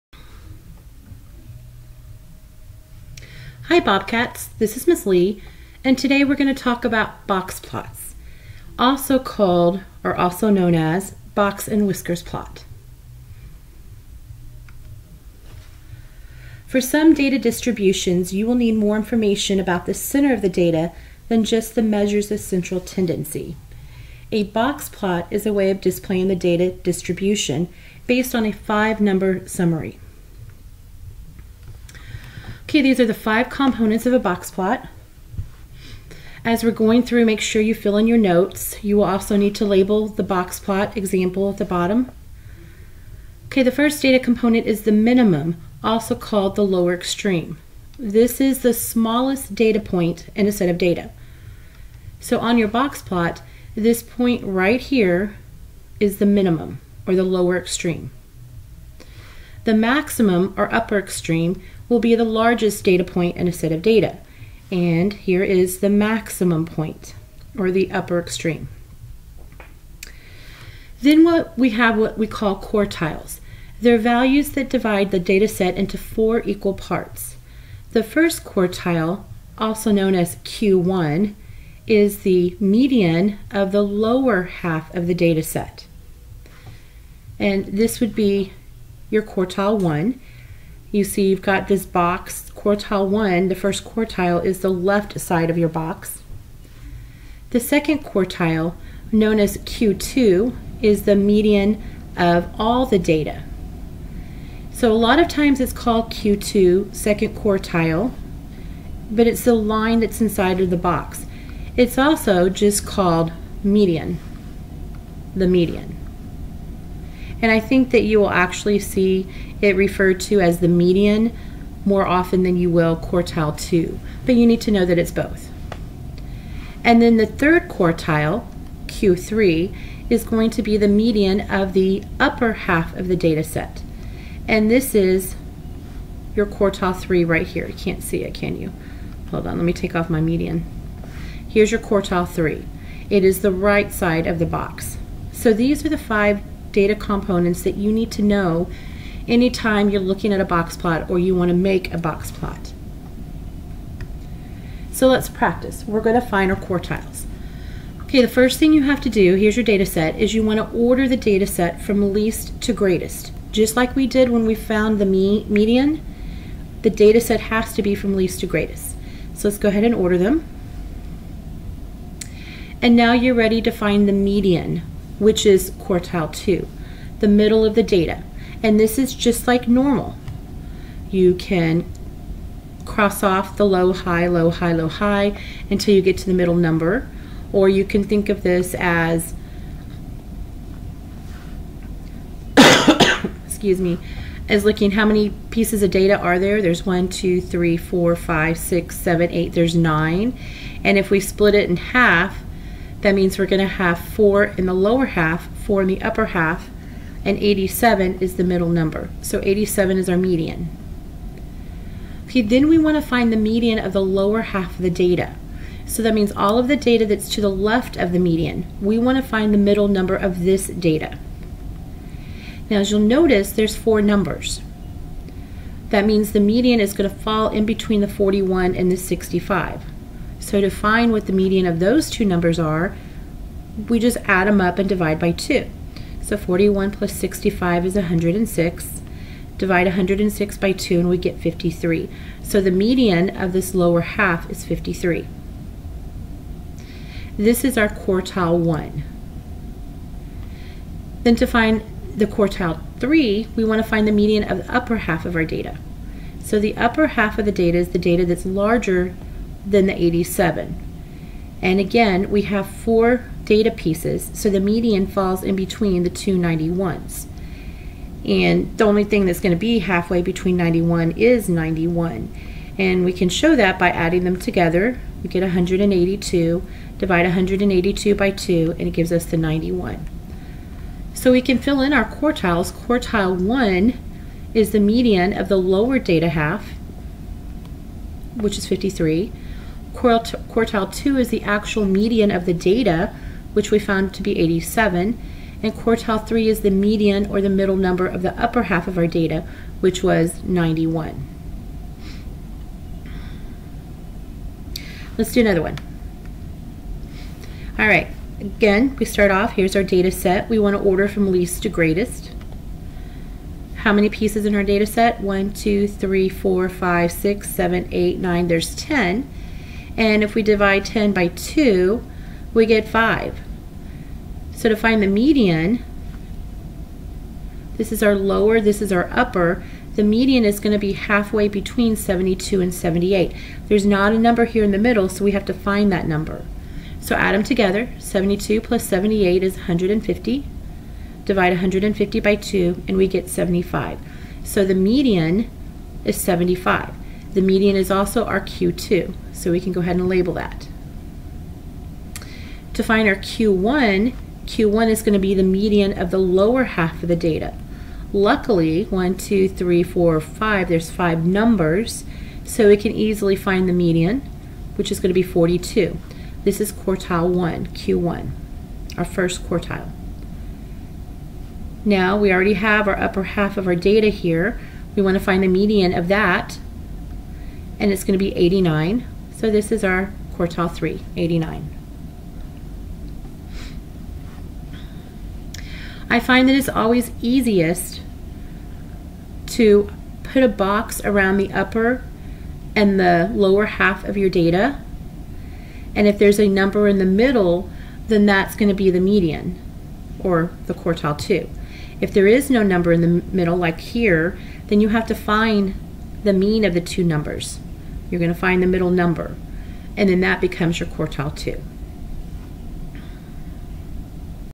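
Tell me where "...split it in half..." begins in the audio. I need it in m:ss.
3:21.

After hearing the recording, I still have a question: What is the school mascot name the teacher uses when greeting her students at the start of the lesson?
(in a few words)
Bobcats.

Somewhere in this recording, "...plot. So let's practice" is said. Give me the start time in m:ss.
2:32.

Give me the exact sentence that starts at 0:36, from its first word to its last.
As we're going through, make sure you fill in your notes.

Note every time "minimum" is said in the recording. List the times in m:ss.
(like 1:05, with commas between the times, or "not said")
0:44, 0:56.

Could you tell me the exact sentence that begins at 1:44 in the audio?
So a lot of times it's called Q2, second quartile, but it's the line that's inside of the box.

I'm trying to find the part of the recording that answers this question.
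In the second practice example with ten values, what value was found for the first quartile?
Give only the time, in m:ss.
6:05.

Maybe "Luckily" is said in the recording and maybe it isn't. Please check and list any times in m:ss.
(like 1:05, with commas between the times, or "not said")
5:58.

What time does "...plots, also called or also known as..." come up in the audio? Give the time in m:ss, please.
0:07.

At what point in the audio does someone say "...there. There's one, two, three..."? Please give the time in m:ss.
3:16.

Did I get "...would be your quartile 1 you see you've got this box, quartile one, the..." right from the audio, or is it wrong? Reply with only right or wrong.
right.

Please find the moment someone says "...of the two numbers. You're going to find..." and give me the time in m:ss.
6:46.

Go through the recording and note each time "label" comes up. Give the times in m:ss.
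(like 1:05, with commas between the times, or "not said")
0:39, 5:50.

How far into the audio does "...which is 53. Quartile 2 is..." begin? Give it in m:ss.
4:48.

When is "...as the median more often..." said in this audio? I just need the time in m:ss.
2:00.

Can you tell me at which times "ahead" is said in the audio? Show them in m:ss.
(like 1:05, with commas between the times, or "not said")
2:49, 5:49.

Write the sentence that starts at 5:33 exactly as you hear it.
There's not a number here in the middle, so we have to find that number.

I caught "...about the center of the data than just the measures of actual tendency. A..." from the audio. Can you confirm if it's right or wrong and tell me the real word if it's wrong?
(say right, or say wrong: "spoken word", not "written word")
wrong: "central", not "actual".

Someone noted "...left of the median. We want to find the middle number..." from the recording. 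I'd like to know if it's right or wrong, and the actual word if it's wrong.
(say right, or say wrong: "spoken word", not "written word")
right.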